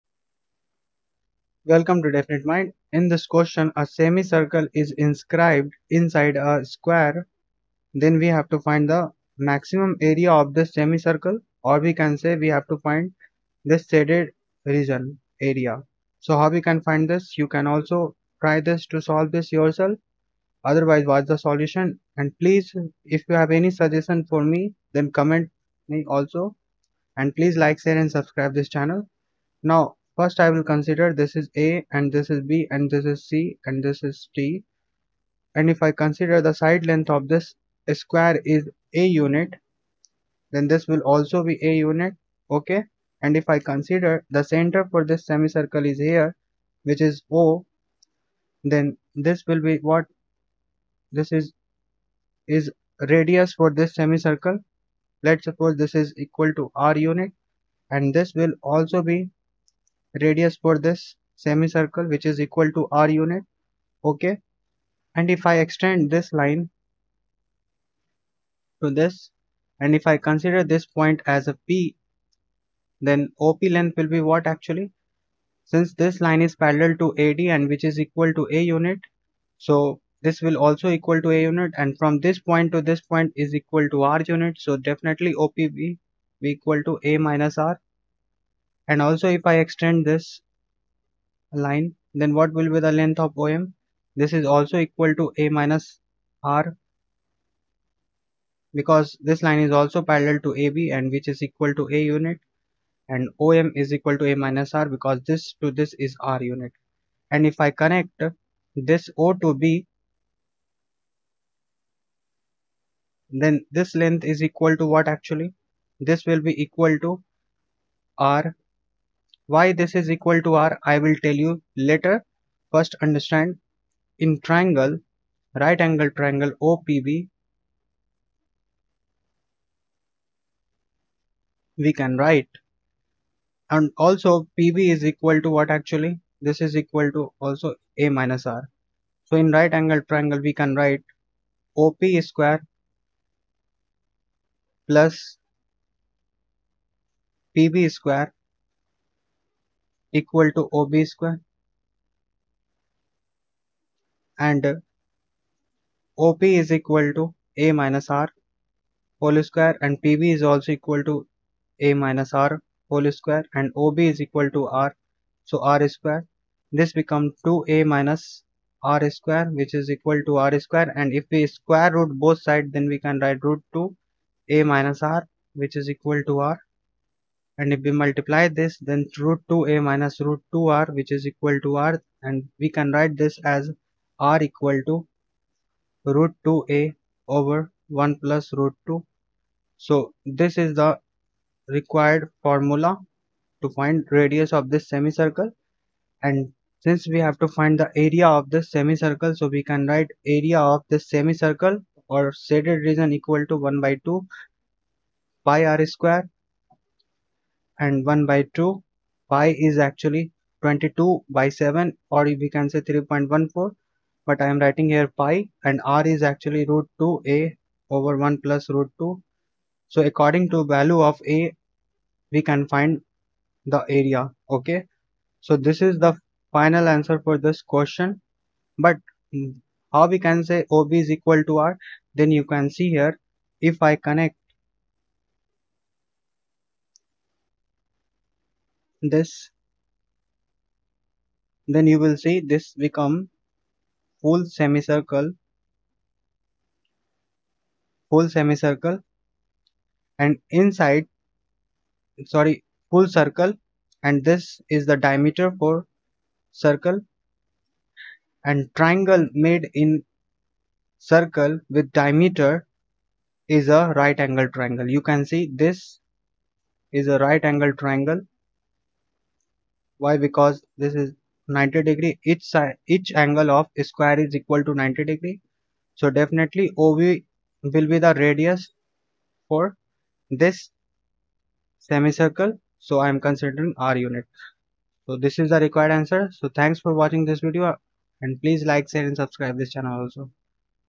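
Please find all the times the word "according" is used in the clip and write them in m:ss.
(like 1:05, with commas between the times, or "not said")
3:40.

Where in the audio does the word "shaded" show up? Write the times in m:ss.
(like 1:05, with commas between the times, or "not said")
0:13, 3:22.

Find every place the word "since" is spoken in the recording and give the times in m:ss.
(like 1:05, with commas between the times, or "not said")
1:15, 3:16.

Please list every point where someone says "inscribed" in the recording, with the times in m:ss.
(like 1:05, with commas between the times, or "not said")
0:04.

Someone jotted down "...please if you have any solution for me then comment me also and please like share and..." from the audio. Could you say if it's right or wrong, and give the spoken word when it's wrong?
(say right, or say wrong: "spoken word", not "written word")
wrong: "suggestion", not "solution".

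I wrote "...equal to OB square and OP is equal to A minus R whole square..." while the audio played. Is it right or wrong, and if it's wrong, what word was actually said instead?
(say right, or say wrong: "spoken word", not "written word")
right.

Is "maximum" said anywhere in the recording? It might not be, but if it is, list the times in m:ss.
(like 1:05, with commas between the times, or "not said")
0:09.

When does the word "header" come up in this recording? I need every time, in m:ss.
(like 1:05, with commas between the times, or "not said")
not said.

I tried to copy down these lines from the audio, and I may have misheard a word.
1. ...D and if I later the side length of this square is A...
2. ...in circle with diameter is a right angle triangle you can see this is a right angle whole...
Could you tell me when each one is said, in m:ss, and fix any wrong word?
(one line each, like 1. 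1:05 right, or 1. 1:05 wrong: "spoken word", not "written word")
1. 0:34 wrong: "consider", not "later"
2. 4:19 wrong: "triangle", not "whole".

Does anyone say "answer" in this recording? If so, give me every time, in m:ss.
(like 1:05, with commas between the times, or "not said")
3:46, 4:45.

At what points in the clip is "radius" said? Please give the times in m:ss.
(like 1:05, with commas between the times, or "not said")
0:53, 1:00, 3:14, 4:38.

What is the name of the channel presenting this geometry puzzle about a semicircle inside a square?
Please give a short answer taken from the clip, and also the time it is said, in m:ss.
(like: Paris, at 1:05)
Definite Mind, at 0:02.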